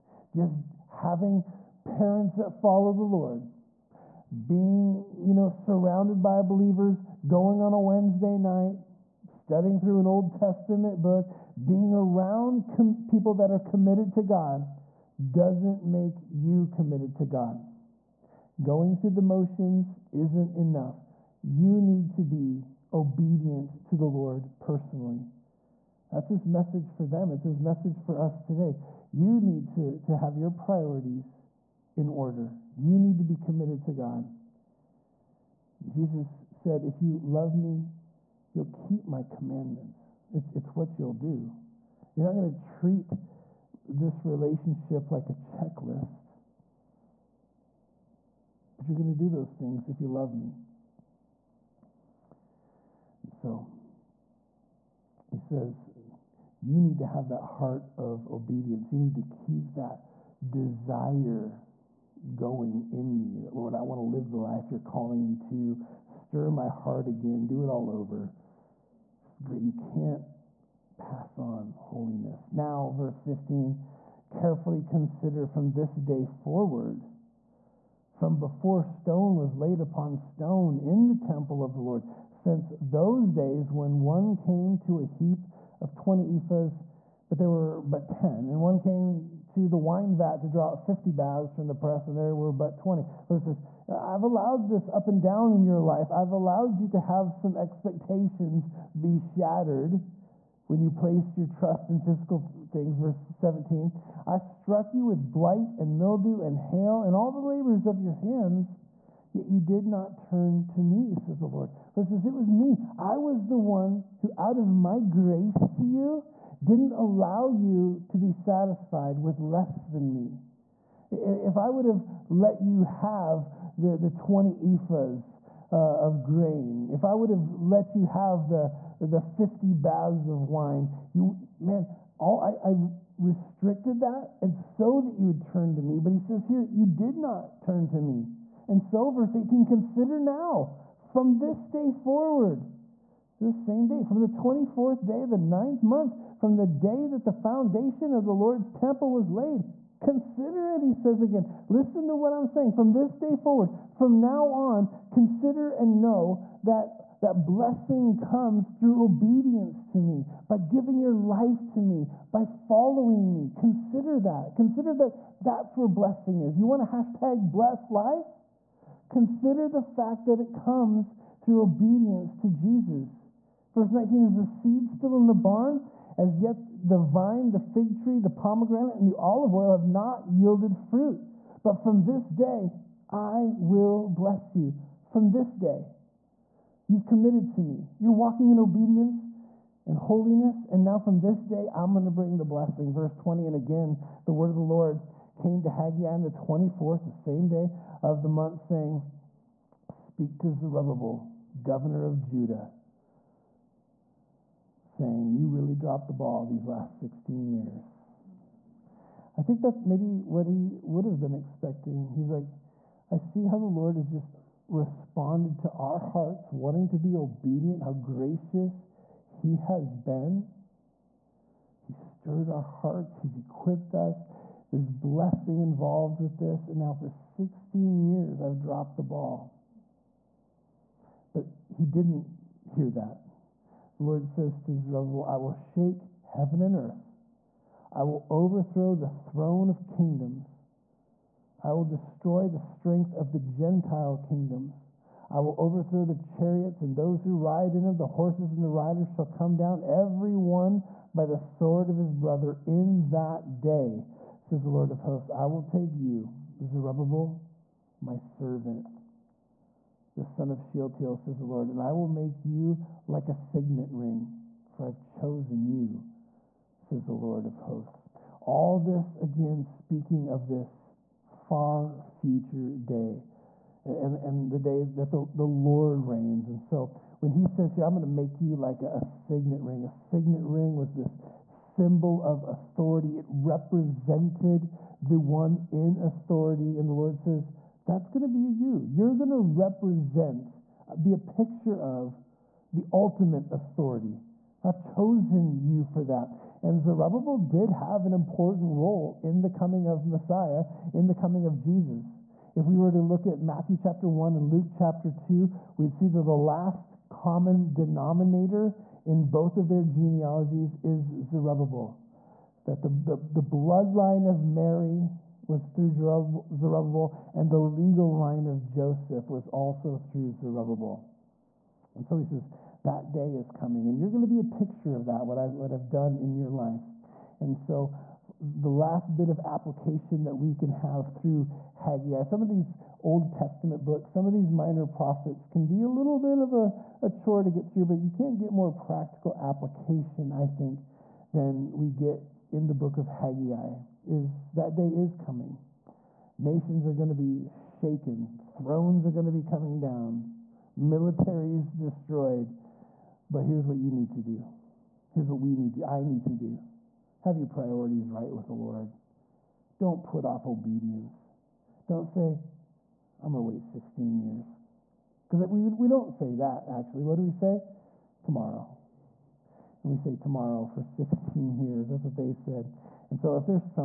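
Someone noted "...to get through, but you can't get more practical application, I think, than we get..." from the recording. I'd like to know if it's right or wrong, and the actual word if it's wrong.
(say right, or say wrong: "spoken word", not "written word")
right.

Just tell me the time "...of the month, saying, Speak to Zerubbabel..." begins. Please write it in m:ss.
3:18.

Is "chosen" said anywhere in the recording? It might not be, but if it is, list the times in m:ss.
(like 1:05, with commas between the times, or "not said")
4:24, 4:54.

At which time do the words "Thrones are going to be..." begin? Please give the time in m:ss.
5:48.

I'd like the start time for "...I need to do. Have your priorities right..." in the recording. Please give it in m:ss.
5:55.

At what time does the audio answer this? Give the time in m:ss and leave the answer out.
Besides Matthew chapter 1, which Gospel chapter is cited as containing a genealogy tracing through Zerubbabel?
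5:04.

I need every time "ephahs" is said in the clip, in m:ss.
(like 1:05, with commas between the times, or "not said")
1:26, 2:04.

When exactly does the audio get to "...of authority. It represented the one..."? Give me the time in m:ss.
4:42.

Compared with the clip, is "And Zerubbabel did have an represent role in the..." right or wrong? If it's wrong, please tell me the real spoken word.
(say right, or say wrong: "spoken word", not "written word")
wrong: "important", not "represent".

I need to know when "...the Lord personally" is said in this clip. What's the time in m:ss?
0:23.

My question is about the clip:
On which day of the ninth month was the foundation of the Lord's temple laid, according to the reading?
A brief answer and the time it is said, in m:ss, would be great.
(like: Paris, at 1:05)
24th, at 2:24.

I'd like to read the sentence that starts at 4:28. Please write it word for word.
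All this, again, speaking of this far future day and, and the day that the, the Lord reigns.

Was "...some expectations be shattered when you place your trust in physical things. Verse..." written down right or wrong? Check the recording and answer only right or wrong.
right.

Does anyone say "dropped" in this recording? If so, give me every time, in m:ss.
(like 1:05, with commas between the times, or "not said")
3:25, 3:48.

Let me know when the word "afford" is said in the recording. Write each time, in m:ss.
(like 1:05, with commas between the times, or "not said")
not said.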